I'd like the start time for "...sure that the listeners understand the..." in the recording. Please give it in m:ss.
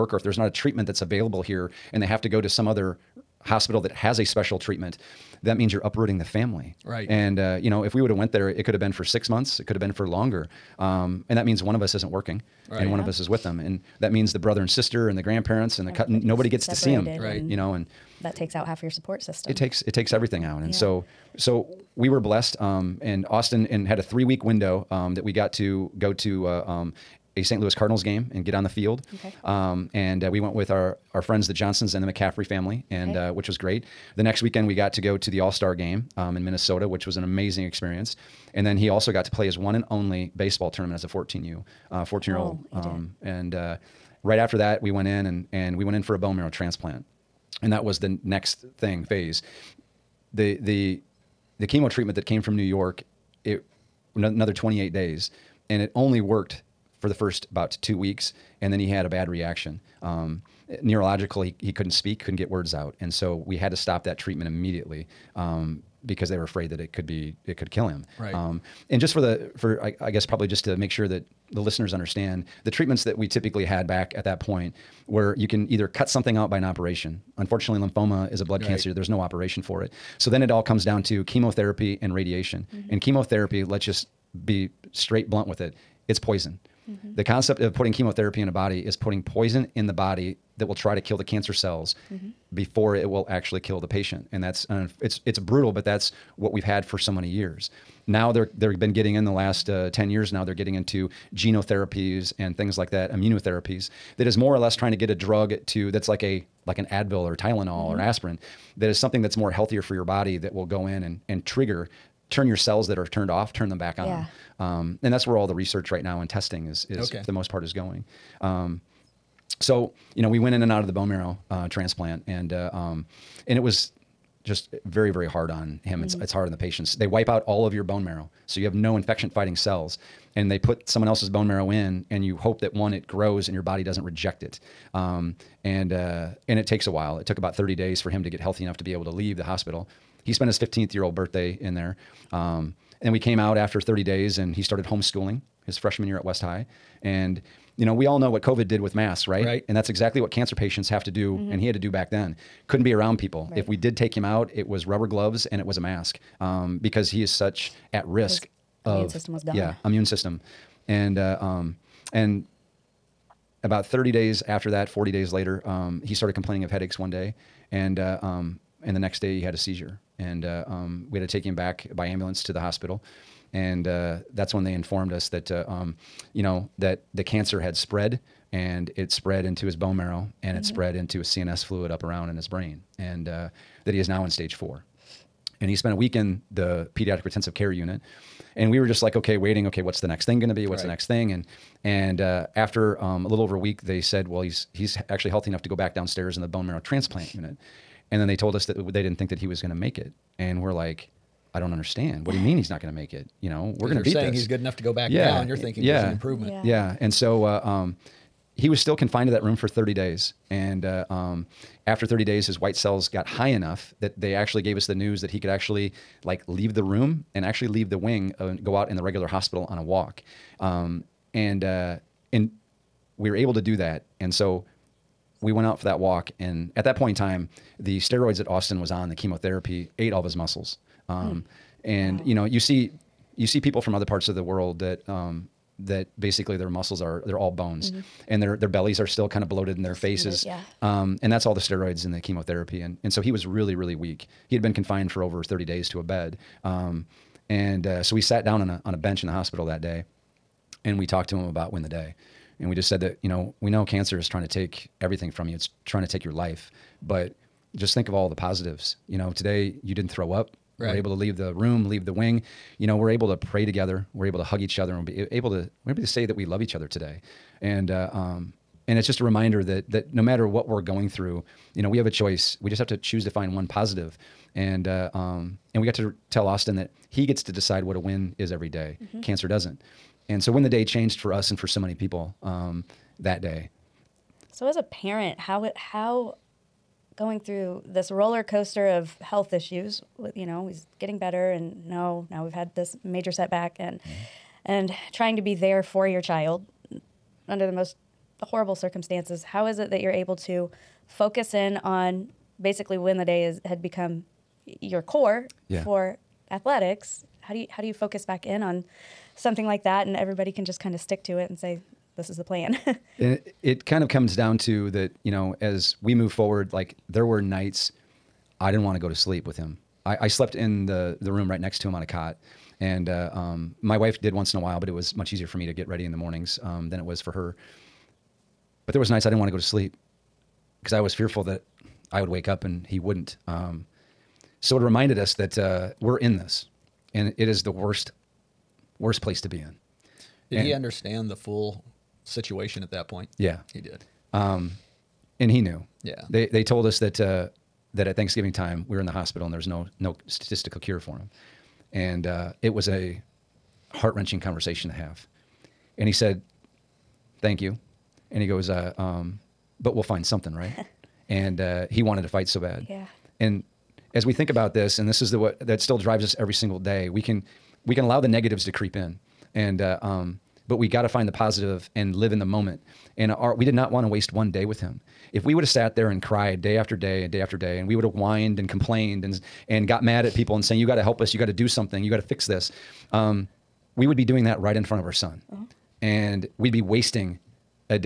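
1:10.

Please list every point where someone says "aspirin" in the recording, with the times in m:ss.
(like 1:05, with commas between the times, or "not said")
1:47.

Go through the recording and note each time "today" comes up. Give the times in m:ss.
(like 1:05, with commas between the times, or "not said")
4:19, 4:26.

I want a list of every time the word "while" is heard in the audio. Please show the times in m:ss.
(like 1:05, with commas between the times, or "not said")
2:16, 5:24.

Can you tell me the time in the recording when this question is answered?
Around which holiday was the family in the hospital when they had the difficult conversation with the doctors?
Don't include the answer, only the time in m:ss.
5:48.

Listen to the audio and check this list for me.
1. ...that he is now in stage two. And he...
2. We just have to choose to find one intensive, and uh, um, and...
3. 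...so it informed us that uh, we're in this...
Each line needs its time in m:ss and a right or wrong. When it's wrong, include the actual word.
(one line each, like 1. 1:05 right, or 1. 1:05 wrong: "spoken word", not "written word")
1. 3:03 wrong: "four", not "two"
2. 4:32 wrong: "positive", not "intensive"
3. 5:34 wrong: "reminded", not "informed".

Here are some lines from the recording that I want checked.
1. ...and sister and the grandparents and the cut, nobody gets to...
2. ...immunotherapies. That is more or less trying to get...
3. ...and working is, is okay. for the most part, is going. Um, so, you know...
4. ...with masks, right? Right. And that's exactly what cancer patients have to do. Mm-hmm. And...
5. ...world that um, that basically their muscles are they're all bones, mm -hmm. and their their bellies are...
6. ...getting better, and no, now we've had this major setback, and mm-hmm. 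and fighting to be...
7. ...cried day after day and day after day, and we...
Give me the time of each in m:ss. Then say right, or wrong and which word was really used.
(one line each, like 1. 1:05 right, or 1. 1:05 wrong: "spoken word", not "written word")
1. 0:14 right
2. 1:43 right
3. 1:56 wrong: "testing", not "working"
4. 2:28 right
5. 3:54 right
6. 4:50 wrong: "trying", not "fighting"
7. 6:16 right.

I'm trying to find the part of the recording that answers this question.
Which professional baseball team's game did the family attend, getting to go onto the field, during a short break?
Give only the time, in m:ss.
0:27.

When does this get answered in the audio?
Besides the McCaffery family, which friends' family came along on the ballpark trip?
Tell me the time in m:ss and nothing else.
0:31.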